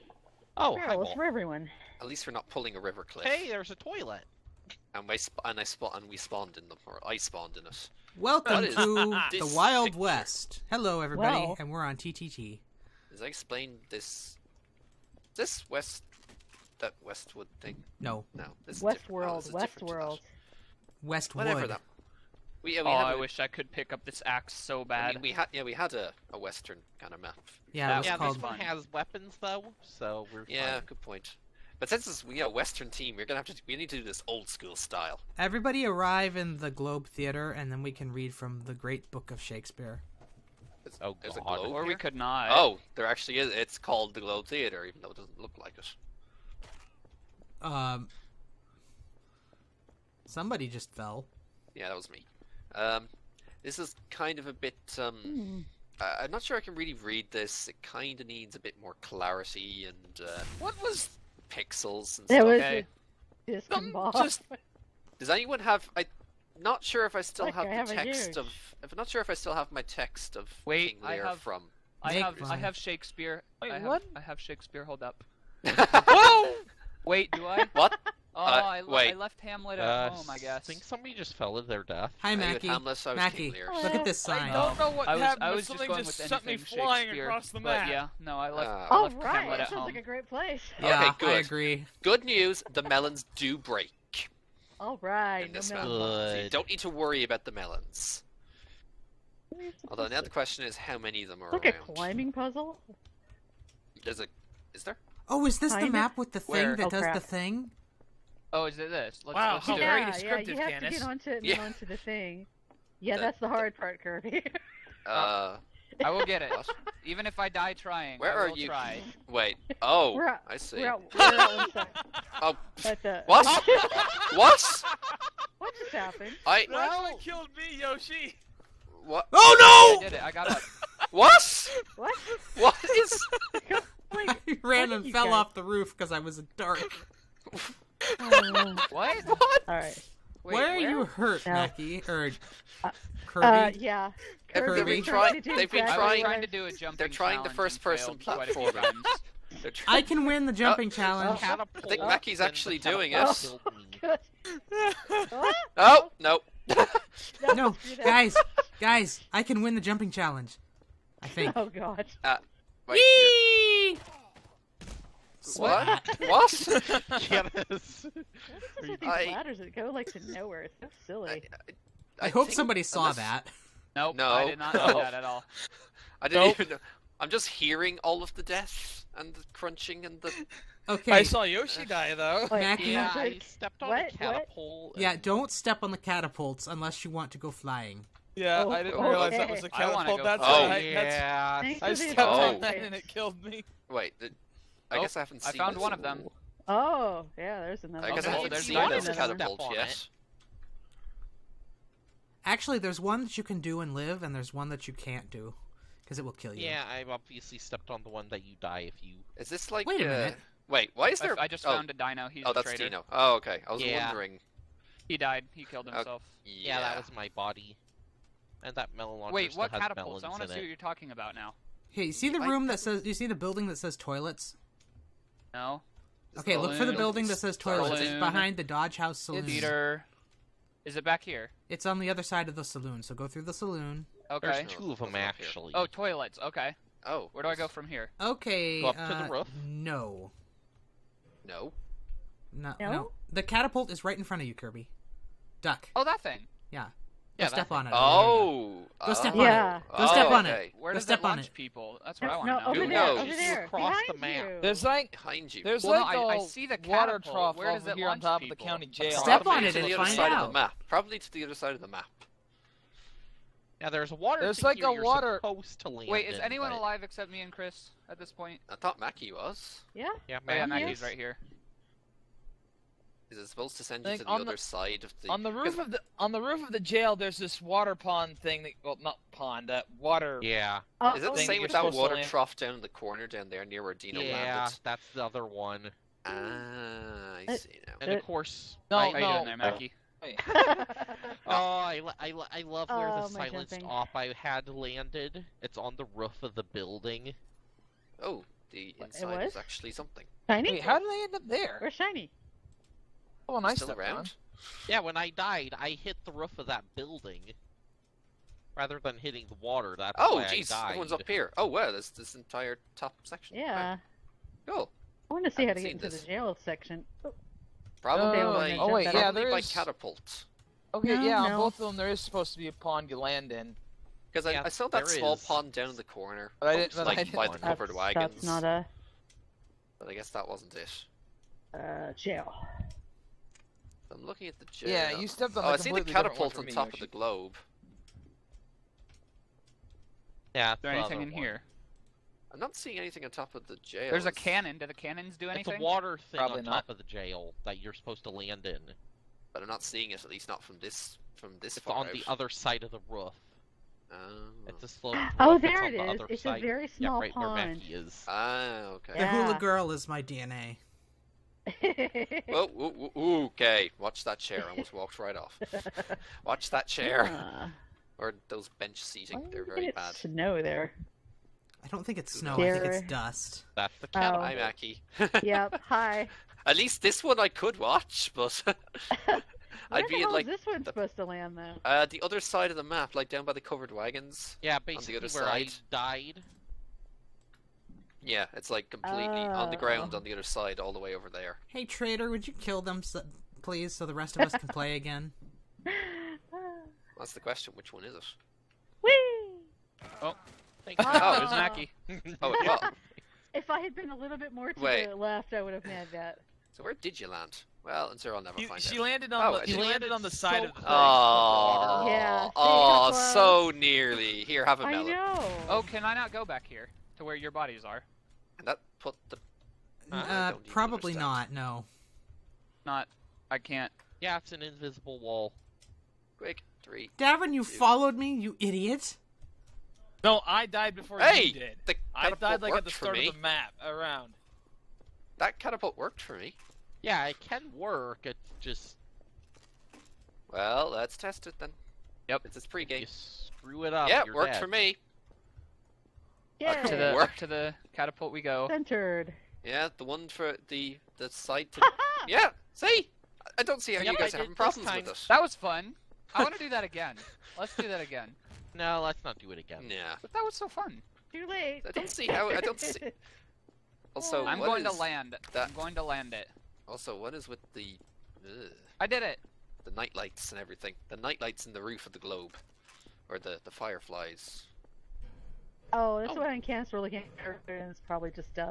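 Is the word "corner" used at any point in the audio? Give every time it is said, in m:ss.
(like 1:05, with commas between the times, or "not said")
4:42, 5:26.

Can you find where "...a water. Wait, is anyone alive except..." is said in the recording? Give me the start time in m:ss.
4:24.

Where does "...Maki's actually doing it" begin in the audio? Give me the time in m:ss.
2:32.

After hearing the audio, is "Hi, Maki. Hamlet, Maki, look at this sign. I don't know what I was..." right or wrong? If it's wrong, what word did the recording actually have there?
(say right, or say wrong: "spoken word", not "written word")
right.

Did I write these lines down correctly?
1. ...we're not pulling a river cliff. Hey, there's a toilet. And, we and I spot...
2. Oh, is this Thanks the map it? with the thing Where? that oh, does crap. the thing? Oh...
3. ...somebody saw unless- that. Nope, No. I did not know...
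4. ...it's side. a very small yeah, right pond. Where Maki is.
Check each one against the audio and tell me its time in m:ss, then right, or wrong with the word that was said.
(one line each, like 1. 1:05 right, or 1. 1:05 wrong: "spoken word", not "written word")
1. 0:02 right
2. 1:45 wrong: "Find", not "Thanks"
3. 2:52 right
4. 5:56 right.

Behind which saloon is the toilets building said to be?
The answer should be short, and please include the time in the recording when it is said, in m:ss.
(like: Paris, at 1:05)
Dodge House Saloon, at 3:48.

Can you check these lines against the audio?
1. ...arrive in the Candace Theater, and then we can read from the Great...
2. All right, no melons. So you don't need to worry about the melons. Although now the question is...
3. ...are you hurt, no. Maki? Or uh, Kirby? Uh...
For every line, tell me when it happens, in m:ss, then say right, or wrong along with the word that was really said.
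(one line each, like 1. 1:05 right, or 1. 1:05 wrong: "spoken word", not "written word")
1. 0:35 wrong: "Globe", not "Candace"
2. 1:34 right
3. 2:20 right.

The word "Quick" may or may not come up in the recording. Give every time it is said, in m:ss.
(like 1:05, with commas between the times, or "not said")
7:06.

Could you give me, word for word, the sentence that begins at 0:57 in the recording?
It kind of needs a bit more clarity.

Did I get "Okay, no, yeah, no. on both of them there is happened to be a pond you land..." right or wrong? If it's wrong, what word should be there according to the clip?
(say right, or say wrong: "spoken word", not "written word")
wrong: "supposed", not "happened".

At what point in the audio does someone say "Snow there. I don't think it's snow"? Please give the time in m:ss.
6:10.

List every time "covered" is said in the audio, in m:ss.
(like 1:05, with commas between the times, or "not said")
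5:27, 6:23.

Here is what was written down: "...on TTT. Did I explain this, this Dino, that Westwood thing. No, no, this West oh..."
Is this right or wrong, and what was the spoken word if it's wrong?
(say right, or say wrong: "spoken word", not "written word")
wrong: "West", not "Dino".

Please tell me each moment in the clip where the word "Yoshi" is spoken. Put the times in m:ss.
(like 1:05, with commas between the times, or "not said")
2:07, 3:01.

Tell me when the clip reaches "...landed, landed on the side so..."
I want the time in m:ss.
6:49.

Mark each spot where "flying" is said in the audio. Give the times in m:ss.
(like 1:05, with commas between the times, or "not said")
1:26, 3:07.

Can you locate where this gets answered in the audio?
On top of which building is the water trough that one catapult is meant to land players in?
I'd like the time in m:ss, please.
4:18.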